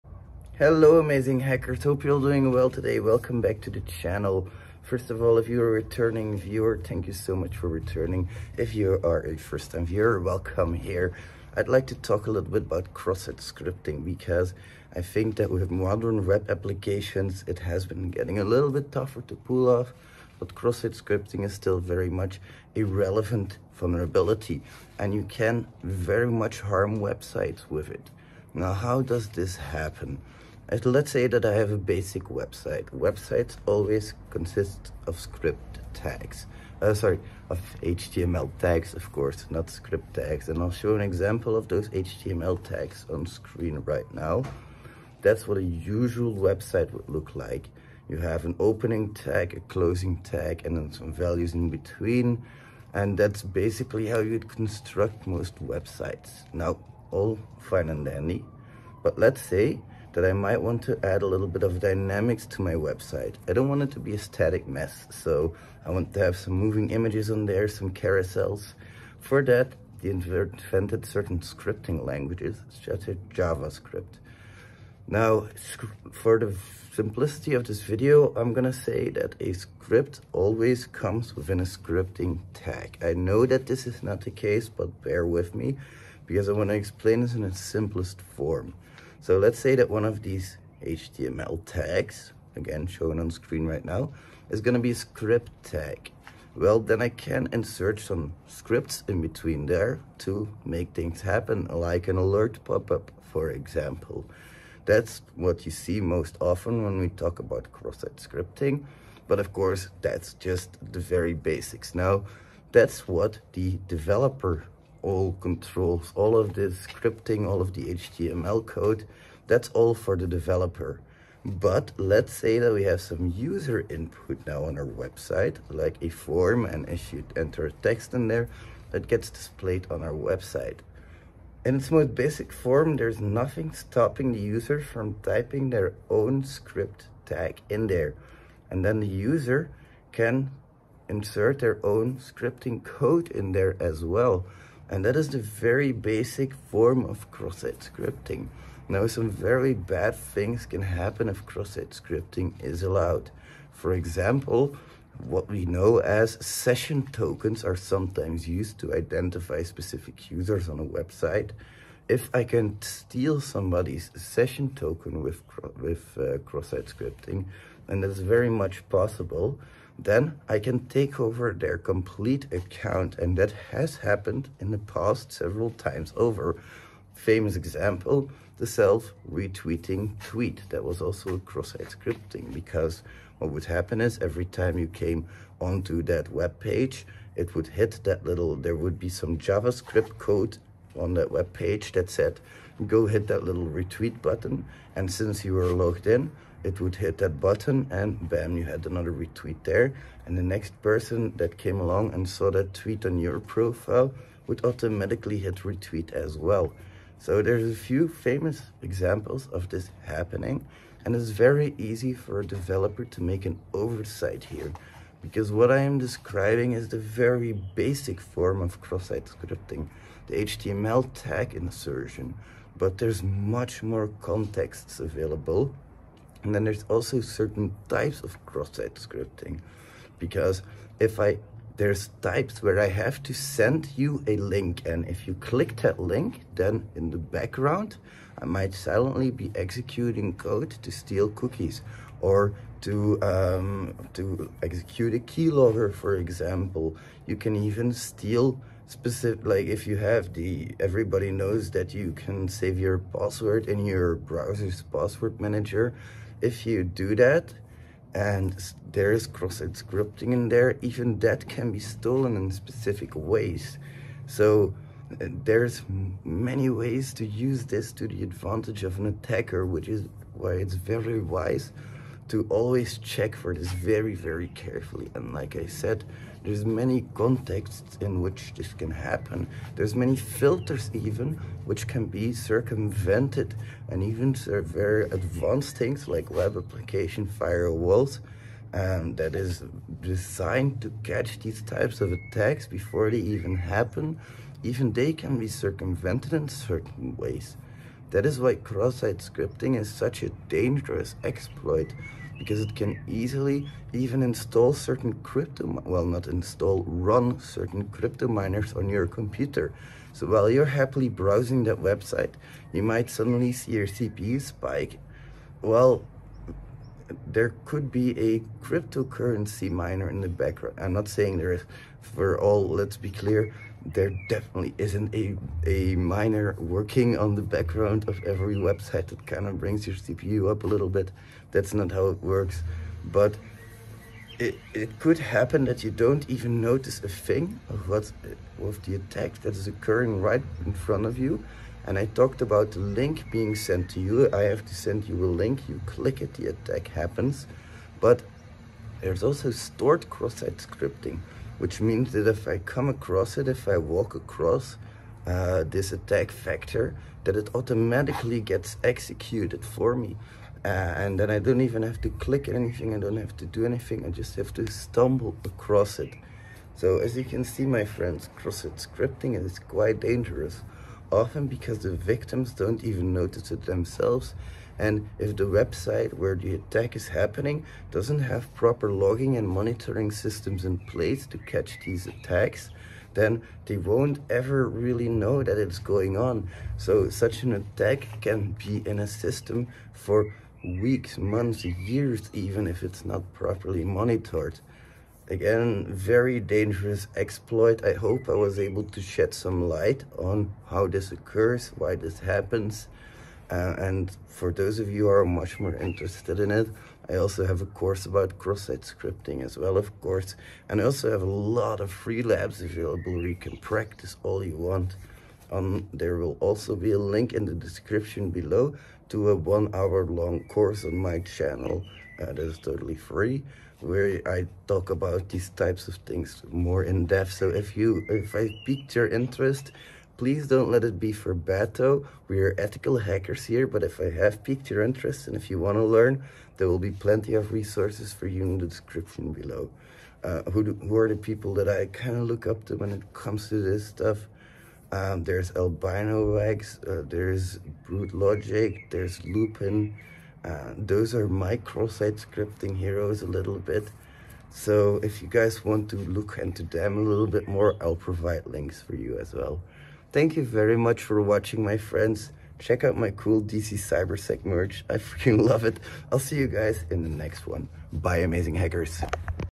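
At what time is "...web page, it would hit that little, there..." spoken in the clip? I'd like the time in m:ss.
3:06.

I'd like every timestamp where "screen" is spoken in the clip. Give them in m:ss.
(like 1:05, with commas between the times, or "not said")
0:43, 1:33.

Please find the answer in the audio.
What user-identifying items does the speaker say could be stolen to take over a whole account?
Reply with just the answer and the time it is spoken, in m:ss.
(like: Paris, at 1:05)
session tokens, at 2:36.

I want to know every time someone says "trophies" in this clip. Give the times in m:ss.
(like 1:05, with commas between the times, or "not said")
not said.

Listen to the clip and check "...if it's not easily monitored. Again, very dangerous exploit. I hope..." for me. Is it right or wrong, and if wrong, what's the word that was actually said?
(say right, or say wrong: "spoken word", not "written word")
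wrong: "properly", not "easily".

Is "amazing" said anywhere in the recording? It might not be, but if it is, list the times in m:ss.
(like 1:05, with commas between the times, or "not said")
0:00, 7:48.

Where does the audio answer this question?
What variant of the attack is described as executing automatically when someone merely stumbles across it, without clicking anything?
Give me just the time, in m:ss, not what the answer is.
5:49.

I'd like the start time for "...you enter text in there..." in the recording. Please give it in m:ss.
2:07.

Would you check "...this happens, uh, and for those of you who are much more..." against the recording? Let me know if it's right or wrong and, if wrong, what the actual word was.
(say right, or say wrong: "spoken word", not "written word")
right.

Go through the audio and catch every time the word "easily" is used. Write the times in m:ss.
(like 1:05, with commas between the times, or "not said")
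5:03.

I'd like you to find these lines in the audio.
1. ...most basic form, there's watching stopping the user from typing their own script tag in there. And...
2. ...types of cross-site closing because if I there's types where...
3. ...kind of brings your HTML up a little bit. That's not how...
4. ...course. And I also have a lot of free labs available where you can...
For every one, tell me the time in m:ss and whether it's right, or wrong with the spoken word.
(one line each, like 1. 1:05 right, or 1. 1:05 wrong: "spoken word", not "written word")
1. 2:11 wrong: "nothing", not "watching"
2. 3:47 wrong: "scripting", not "closing"
3. 5:29 wrong: "CPU", not "HTML"
4. 6:49 right.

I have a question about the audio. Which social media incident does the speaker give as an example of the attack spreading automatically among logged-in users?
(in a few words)
self-retweeting tweet.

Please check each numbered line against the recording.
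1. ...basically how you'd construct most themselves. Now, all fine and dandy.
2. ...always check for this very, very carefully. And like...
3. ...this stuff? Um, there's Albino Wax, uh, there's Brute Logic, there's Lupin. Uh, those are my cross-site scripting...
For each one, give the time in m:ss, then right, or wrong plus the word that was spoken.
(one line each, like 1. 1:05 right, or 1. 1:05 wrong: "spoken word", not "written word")
1. 0:53 wrong: "websites", not "themselves"
2. 4:32 right
3. 7:23 right.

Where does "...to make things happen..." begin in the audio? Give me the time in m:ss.
1:40.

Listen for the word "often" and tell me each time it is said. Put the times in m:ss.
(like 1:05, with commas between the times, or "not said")
1:46, 6:11.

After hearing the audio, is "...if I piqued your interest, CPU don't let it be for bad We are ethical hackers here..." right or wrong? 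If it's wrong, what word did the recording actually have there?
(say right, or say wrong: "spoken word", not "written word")
wrong: "Please", not "CPU".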